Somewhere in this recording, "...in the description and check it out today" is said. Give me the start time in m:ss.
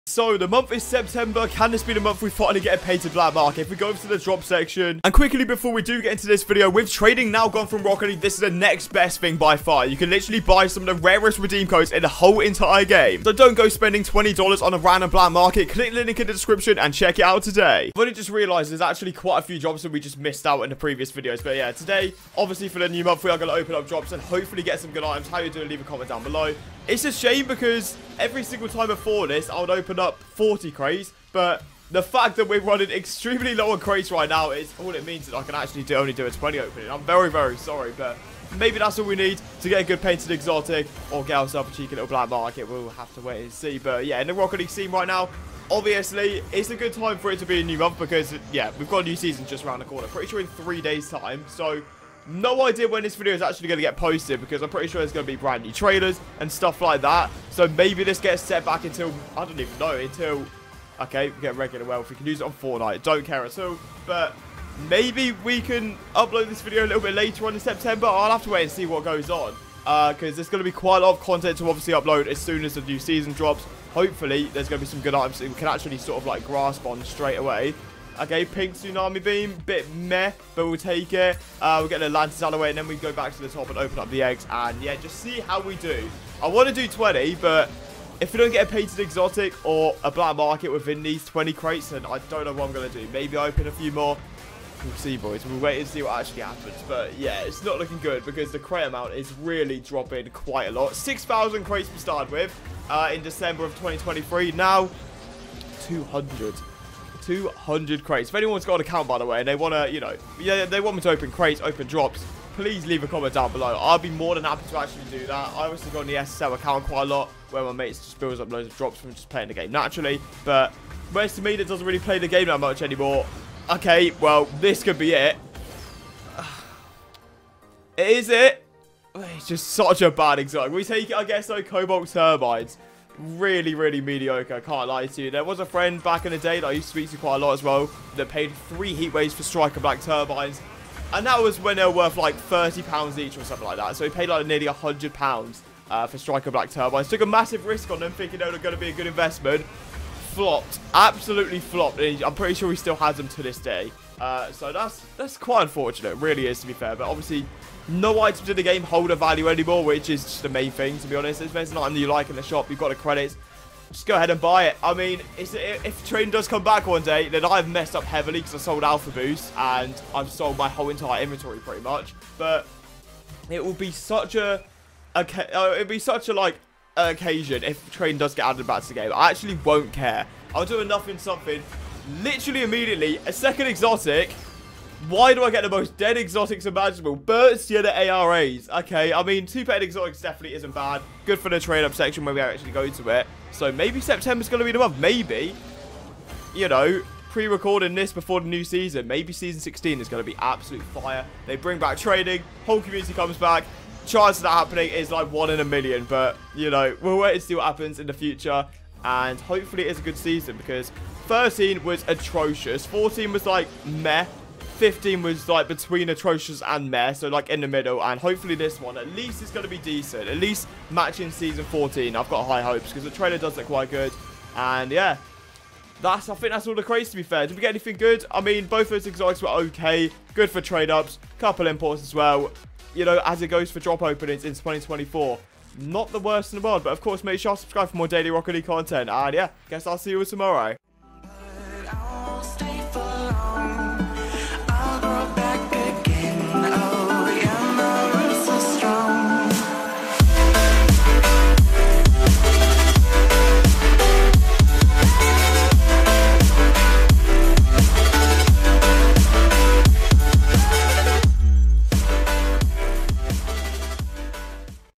0:16.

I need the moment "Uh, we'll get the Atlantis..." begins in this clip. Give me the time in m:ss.
1:21.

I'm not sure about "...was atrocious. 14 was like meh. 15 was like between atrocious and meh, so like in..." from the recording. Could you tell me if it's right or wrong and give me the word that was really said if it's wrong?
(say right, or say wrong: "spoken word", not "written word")
right.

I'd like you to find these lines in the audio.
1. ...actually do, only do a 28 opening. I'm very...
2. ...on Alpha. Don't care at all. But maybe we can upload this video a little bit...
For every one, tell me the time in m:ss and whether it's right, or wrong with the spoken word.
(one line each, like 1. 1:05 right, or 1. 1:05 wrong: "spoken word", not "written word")
1. 0:35 wrong: "20", not "28"
2. 1:02 wrong: "Fortnite", not "Alpha".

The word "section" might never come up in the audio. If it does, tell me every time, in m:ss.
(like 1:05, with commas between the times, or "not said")
0:04, 3:11.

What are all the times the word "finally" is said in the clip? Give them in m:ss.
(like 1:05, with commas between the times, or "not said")
0:02.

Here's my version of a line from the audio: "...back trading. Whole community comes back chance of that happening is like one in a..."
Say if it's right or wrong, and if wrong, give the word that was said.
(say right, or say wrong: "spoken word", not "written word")
right.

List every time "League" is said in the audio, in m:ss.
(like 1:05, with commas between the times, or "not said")
0:08, 0:44, 3:58.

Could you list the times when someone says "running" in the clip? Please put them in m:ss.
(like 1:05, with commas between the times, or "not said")
0:32.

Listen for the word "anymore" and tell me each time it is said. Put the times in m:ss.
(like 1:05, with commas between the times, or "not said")
2:02, 2:39.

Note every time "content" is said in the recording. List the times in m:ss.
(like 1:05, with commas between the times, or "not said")
1:11, 3:58.